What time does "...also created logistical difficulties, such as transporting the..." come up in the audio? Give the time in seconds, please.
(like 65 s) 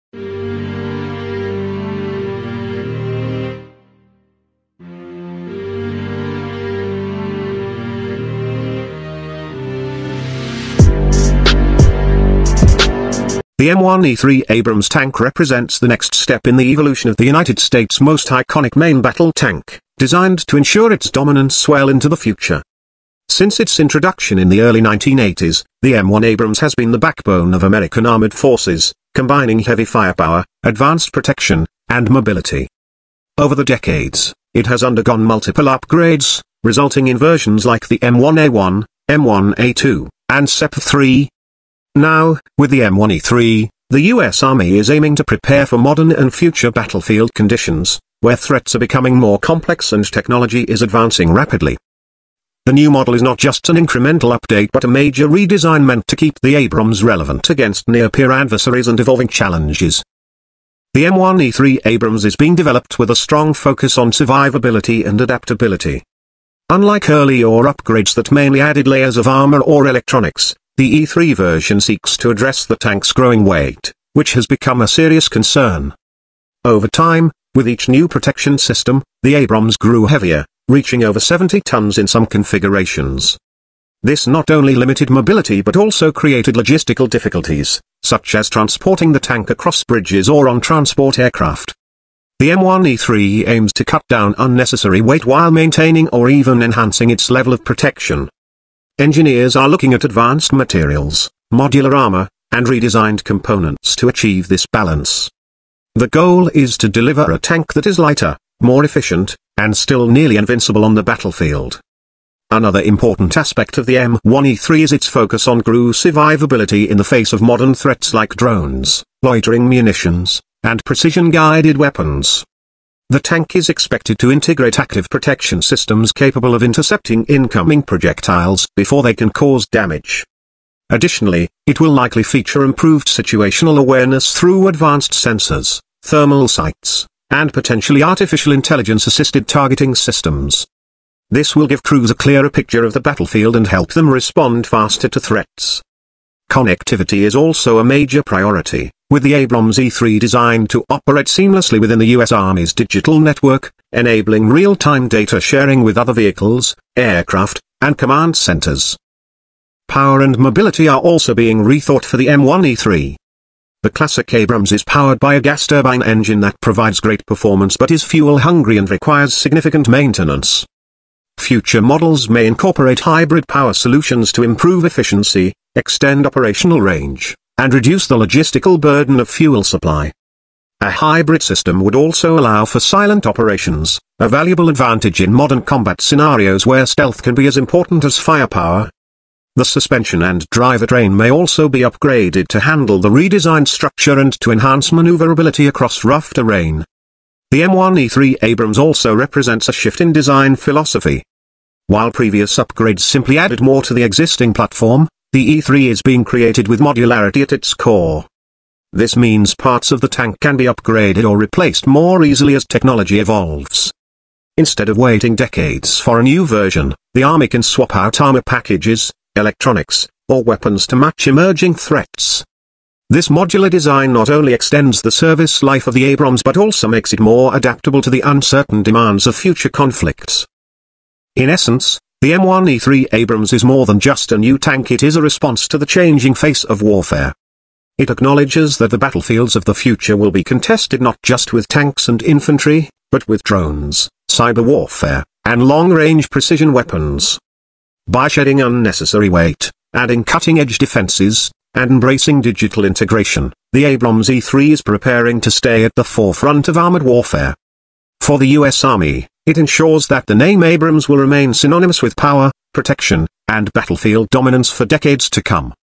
85 s.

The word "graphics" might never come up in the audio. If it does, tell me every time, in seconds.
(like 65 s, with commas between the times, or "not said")
not said.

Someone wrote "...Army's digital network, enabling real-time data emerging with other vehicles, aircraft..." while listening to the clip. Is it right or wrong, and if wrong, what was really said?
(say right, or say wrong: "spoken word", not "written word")
wrong: "sharing", not "emerging".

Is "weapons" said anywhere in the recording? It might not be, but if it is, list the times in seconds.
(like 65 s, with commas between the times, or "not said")
121 s, 220 s, 246 s.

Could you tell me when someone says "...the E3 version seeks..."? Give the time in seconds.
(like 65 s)
70 s.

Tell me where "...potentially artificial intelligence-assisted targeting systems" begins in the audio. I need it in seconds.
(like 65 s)
137 s.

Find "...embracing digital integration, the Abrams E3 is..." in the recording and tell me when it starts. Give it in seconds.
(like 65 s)
251 s.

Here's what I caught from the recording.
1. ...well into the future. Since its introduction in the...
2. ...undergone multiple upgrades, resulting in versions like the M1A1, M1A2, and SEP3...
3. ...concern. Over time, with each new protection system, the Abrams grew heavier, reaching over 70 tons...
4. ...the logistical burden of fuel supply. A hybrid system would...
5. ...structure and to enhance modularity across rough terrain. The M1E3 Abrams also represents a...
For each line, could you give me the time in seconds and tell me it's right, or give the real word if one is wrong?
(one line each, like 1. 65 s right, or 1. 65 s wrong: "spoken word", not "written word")
1. 21 s right
2. 34 s right
3. 75 s right
4. 178 s right
5. 193 s wrong: "maneuverability", not "modularity".